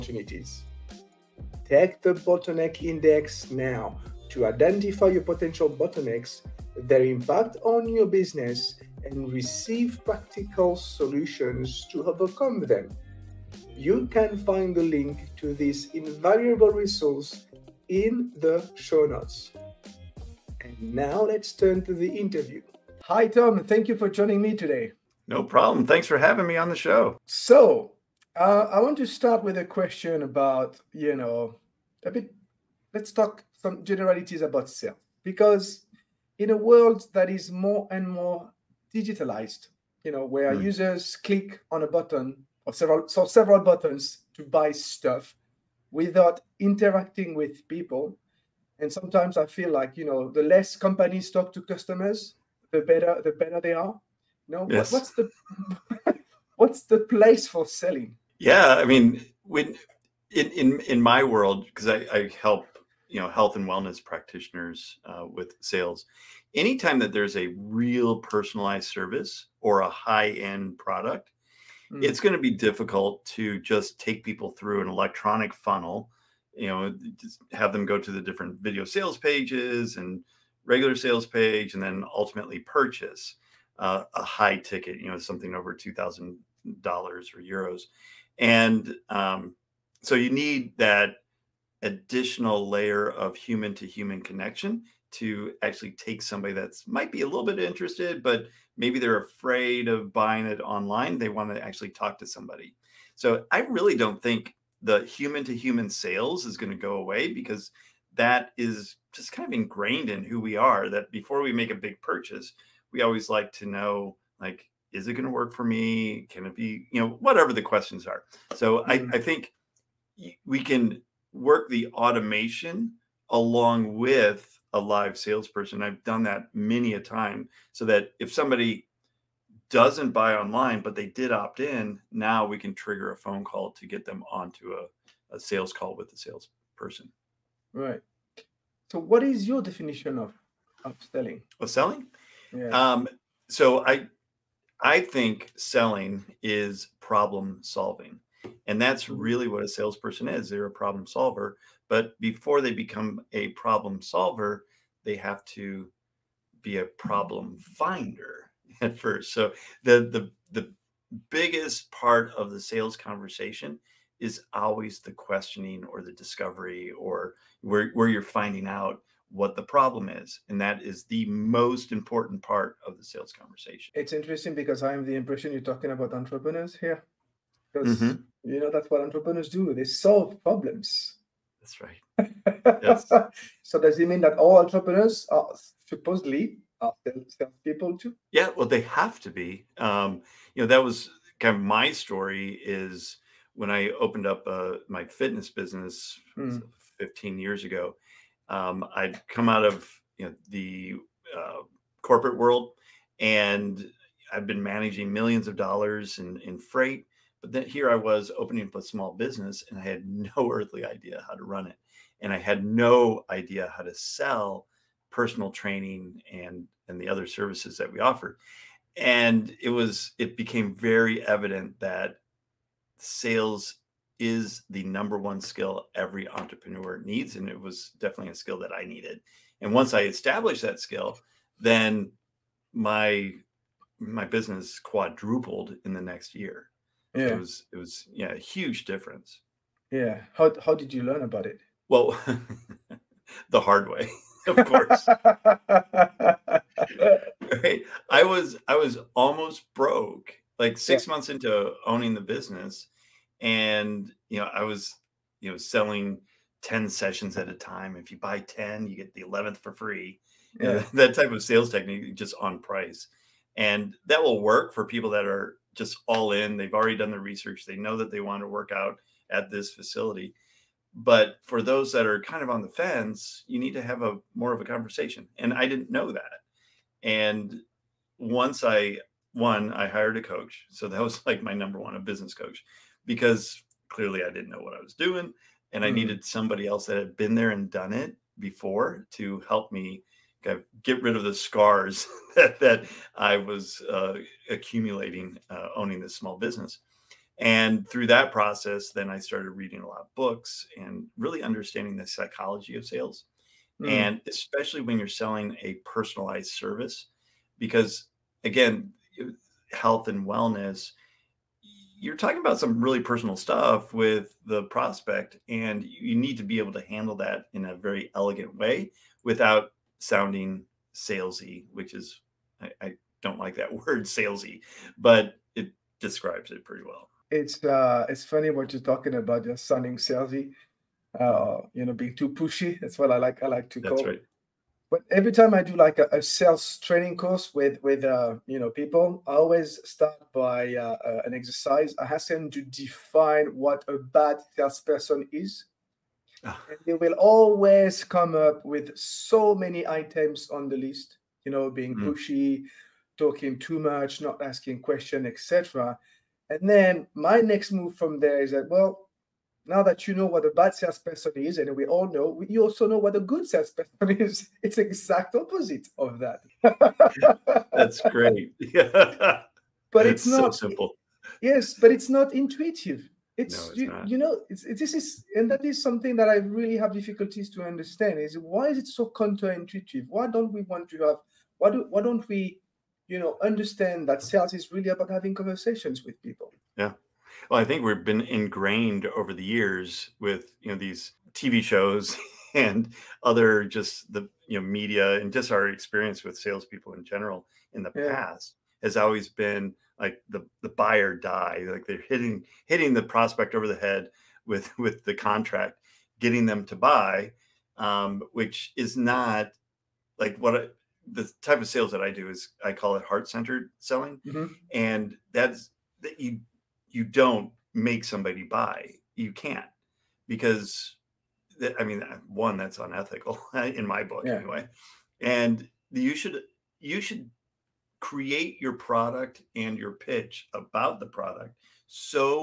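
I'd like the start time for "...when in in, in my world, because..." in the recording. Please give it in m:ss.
0:59.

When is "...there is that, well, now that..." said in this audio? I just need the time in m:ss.
5:58.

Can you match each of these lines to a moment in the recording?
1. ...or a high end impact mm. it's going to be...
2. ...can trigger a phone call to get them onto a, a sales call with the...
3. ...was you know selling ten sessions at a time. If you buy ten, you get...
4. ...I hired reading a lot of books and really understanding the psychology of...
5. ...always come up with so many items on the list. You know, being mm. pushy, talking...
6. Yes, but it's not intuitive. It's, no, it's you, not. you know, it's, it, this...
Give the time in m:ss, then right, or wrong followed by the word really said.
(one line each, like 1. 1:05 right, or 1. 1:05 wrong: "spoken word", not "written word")
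1. 1:09 wrong: "product", not "impact"
2. 2:12 right
3. 4:14 right
4. 4:59 wrong: "started", not "hired"
5. 5:47 right
6. 6:11 right.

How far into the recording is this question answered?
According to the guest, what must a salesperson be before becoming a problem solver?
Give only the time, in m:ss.
2:36.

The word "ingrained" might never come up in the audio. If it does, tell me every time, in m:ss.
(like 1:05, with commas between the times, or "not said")
1:49, 6:28.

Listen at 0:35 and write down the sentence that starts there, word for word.
Because in a world that is more and more digitalized, you know, where mm.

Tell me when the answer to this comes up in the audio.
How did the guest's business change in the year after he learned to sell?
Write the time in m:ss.
3:54.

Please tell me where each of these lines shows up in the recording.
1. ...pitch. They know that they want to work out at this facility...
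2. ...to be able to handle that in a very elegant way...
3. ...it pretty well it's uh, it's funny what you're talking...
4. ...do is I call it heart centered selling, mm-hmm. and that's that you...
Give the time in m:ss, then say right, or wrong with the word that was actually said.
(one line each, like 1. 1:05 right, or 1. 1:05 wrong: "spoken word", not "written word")
1. 4:27 wrong: "research", not "pitch"
2. 5:16 right
3. 5:26 right
4. 6:52 right.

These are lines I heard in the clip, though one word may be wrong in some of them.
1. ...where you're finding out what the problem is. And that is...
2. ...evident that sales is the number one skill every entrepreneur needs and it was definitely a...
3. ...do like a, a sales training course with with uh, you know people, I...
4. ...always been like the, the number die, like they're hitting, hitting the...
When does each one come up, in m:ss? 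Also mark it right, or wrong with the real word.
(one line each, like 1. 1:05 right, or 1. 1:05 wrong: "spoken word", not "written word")
1. 2:47 right
2. 3:41 right
3. 5:35 right
4. 6:38 wrong: "buyer", not "number".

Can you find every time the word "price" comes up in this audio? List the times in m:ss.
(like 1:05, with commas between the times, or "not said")
4:22.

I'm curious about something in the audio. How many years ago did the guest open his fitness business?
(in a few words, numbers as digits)
15.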